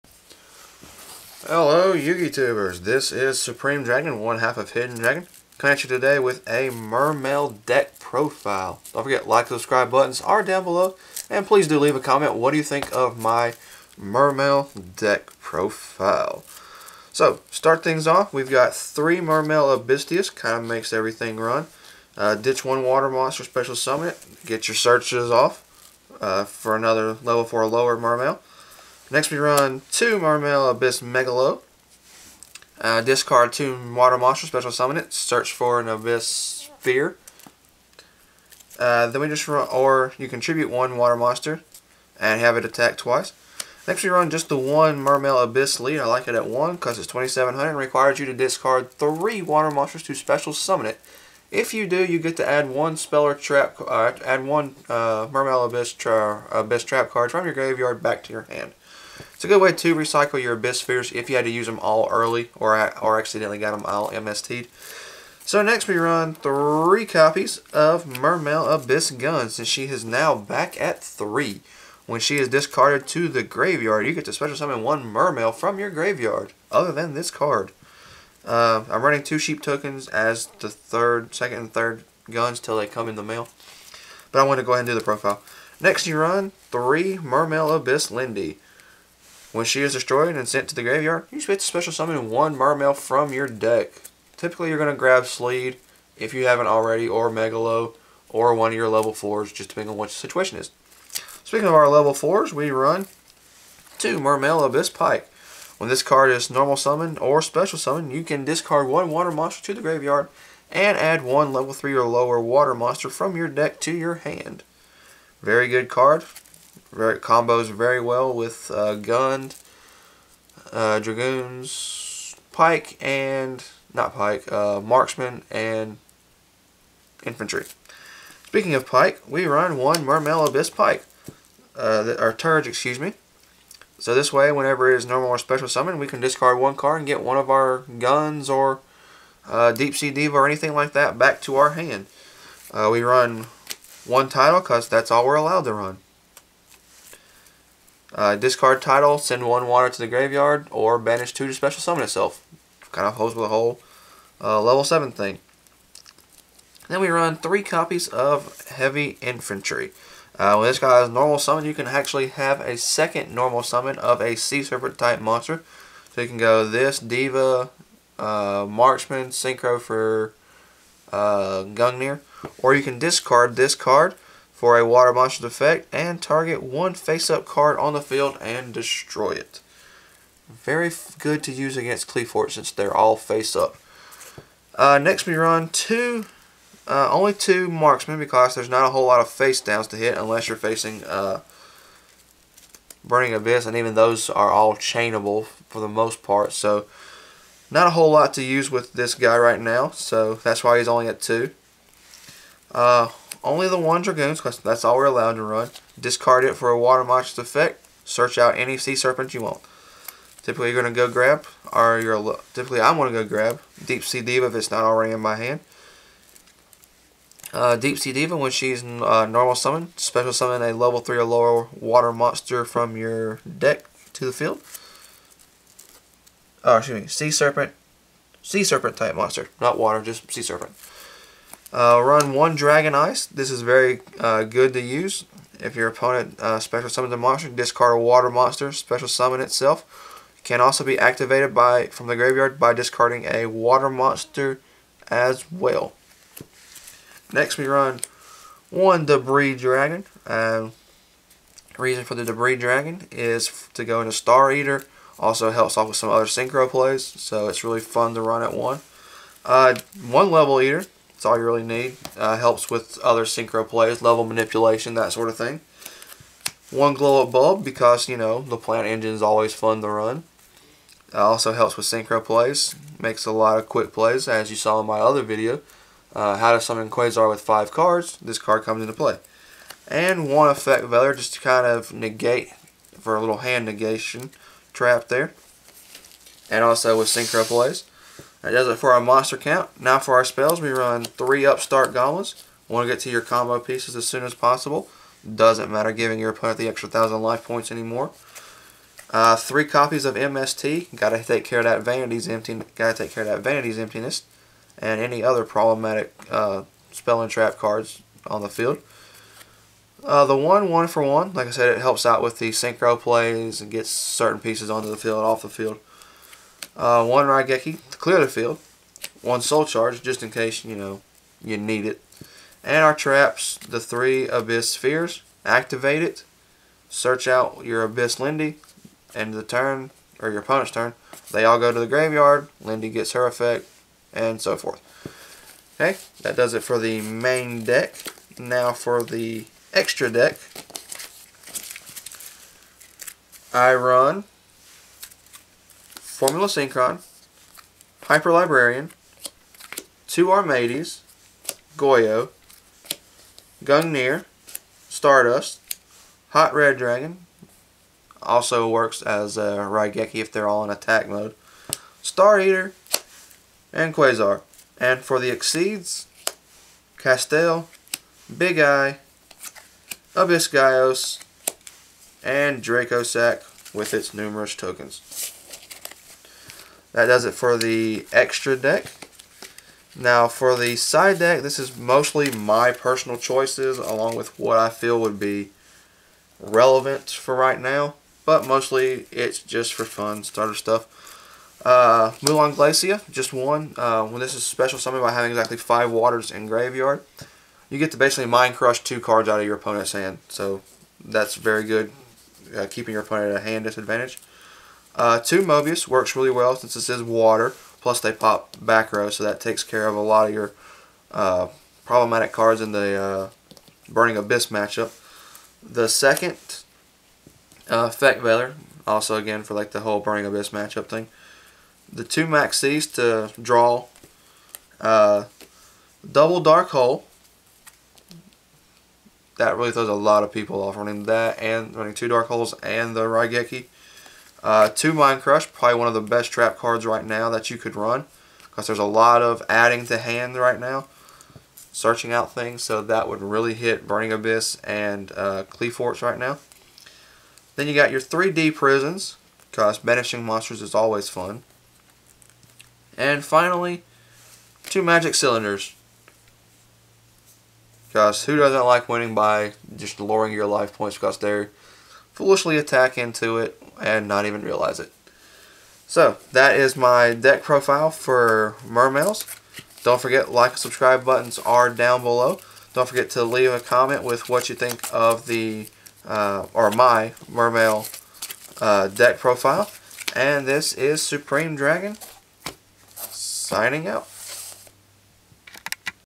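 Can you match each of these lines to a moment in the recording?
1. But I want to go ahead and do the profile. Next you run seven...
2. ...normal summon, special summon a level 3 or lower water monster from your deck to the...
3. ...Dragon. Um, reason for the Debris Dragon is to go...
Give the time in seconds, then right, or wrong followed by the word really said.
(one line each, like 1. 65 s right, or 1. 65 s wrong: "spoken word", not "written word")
1. 84 s wrong: "three", not "seven"
2. 219 s right
3. 249 s right.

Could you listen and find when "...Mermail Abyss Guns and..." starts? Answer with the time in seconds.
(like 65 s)
68 s.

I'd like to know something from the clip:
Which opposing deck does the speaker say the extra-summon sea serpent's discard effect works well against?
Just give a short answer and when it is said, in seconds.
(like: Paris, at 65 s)
Qliphort, at 182 s.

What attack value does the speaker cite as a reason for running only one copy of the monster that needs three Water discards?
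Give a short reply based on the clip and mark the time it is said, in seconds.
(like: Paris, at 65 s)
2700, at 47 s.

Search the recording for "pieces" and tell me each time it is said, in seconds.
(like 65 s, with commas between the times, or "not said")
293 s, 314 s.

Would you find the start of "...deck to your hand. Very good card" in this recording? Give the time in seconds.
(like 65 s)
113 s.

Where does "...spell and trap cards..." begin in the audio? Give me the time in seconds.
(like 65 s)
306 s.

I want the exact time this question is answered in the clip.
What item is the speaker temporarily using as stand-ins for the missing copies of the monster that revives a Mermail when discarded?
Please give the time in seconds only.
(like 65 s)
79 s.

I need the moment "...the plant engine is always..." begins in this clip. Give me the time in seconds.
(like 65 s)
268 s.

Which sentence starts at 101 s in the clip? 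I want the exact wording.
Speaking of our level 4s, we run two Mermail Abyss Pike.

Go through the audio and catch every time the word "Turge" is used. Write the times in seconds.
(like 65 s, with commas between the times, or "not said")
132 s.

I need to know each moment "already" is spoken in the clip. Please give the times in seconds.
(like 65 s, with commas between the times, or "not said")
96 s, 214 s.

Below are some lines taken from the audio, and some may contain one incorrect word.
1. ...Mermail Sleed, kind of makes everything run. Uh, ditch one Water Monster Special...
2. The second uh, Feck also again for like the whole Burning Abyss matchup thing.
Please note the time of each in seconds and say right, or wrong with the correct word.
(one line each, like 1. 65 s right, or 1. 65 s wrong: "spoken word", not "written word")
1. 19 s wrong: "Abysteus", not "Sleed"
2. 415 s right.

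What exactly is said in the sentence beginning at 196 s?
So not a whole lot to use with this guy right now so that's why he's only at two.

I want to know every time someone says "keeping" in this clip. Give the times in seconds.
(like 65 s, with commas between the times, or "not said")
402 s.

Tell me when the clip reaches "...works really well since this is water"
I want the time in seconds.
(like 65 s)
405 s.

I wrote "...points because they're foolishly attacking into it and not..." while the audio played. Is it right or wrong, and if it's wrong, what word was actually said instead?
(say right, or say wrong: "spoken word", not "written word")
right.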